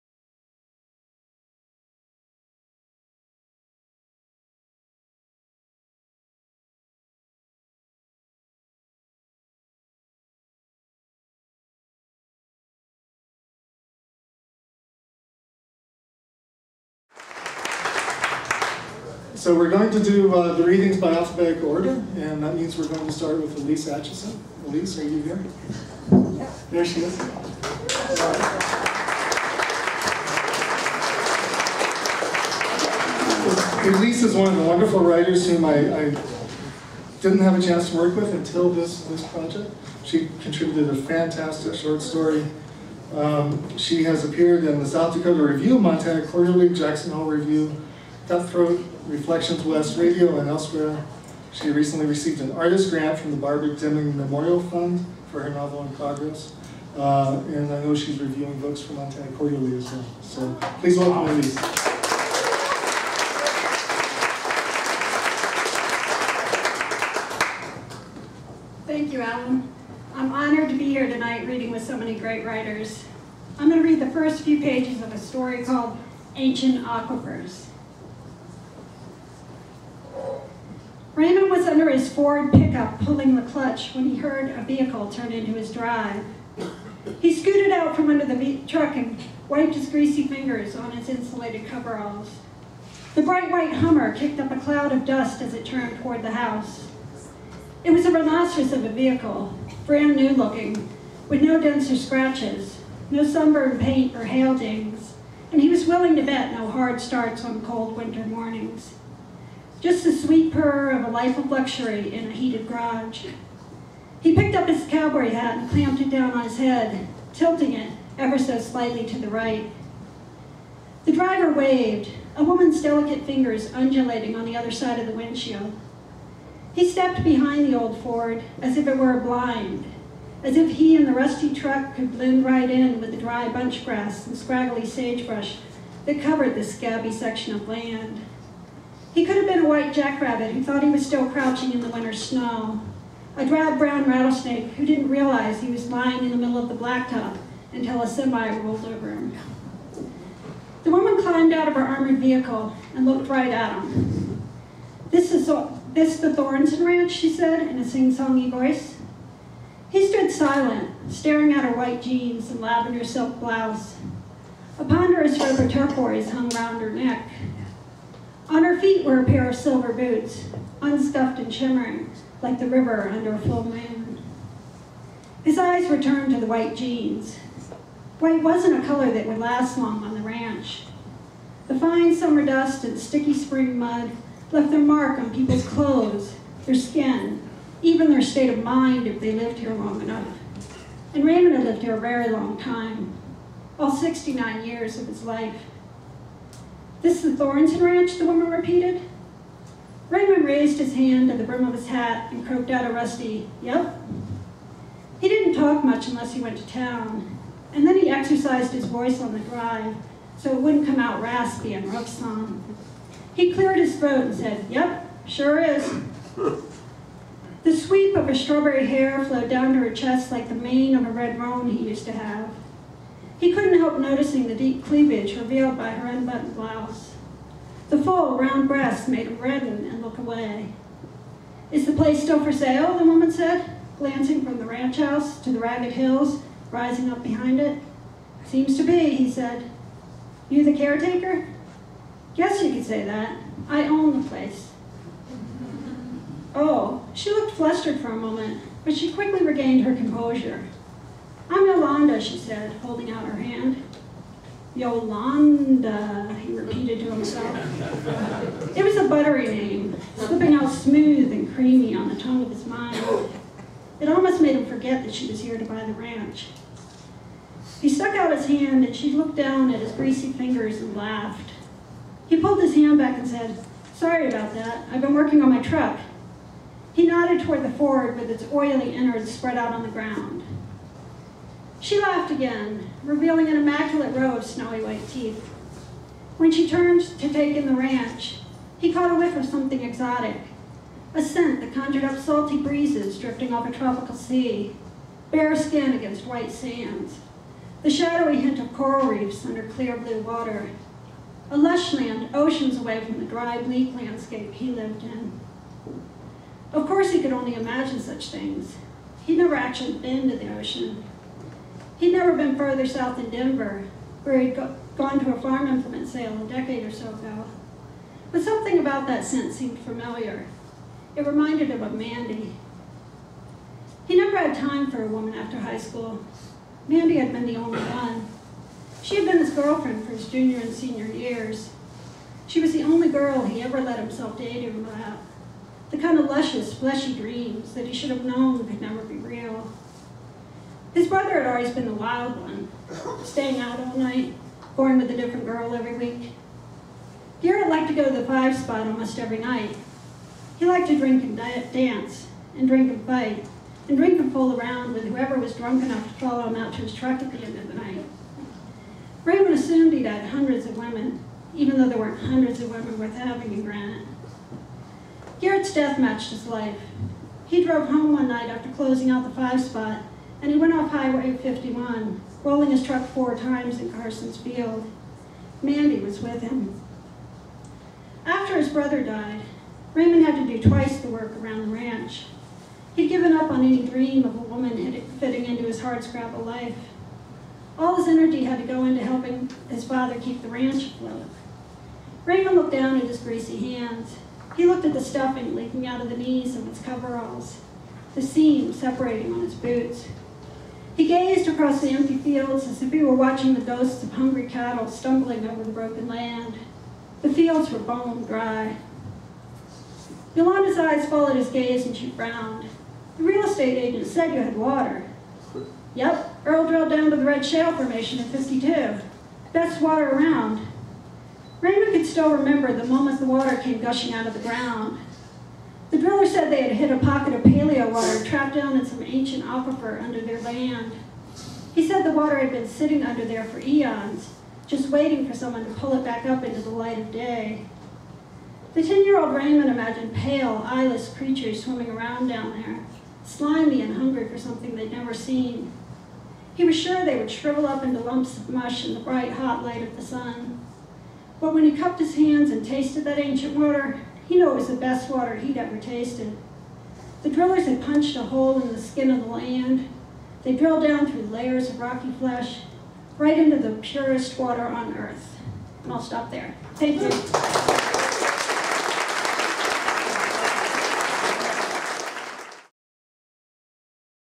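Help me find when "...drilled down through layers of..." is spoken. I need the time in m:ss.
7:40.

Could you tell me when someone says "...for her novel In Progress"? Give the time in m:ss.
0:55.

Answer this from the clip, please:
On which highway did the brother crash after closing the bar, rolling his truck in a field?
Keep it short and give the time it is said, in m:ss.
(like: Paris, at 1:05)
Highway 51, at 6:10.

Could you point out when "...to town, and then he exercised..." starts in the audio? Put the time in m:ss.
3:26.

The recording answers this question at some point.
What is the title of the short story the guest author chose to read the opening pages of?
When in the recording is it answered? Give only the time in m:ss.
1:16.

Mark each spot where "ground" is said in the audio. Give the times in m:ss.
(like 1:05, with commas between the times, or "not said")
4:39, 7:04.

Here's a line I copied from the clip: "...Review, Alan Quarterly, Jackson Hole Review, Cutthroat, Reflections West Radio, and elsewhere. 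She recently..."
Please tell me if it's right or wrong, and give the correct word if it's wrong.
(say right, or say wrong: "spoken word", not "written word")
wrong: "Montana", not "Alan".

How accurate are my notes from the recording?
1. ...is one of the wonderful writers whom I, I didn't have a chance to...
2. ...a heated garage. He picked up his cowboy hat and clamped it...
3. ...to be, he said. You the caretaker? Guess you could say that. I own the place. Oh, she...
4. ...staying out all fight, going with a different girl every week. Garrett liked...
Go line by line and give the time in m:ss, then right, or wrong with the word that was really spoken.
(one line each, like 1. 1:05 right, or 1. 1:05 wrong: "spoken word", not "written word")
1. 0:34 right
2. 1:52 right
3. 3:58 right
4. 5:43 wrong: "night", not "fight".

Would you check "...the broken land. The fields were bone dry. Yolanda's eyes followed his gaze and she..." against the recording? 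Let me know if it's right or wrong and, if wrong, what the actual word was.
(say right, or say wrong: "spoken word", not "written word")
right.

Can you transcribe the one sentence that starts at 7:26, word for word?
He was sure they would shrivel up into lumps of mush in the bright, hot light of the sun.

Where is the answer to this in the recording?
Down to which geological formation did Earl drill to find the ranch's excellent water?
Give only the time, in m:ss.
6:57.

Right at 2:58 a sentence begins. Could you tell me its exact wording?
White wasn't a color that would last long on the ranch.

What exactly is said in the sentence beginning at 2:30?
The woman climbed out of her armored vehicle and looked right at him.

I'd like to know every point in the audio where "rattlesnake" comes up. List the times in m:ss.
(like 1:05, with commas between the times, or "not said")
2:24.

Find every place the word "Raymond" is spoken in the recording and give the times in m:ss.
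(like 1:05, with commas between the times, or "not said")
1:21, 3:11, 3:20, 5:59, 6:19, 6:32, 7:01, 7:19.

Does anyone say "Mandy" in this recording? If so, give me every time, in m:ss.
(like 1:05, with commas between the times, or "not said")
5:21, 5:26, 6:15.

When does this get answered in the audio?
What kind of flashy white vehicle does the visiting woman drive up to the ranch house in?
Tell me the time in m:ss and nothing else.
1:33.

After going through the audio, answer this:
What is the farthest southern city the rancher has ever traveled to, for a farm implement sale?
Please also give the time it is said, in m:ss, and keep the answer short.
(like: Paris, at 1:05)
Denver, at 5:13.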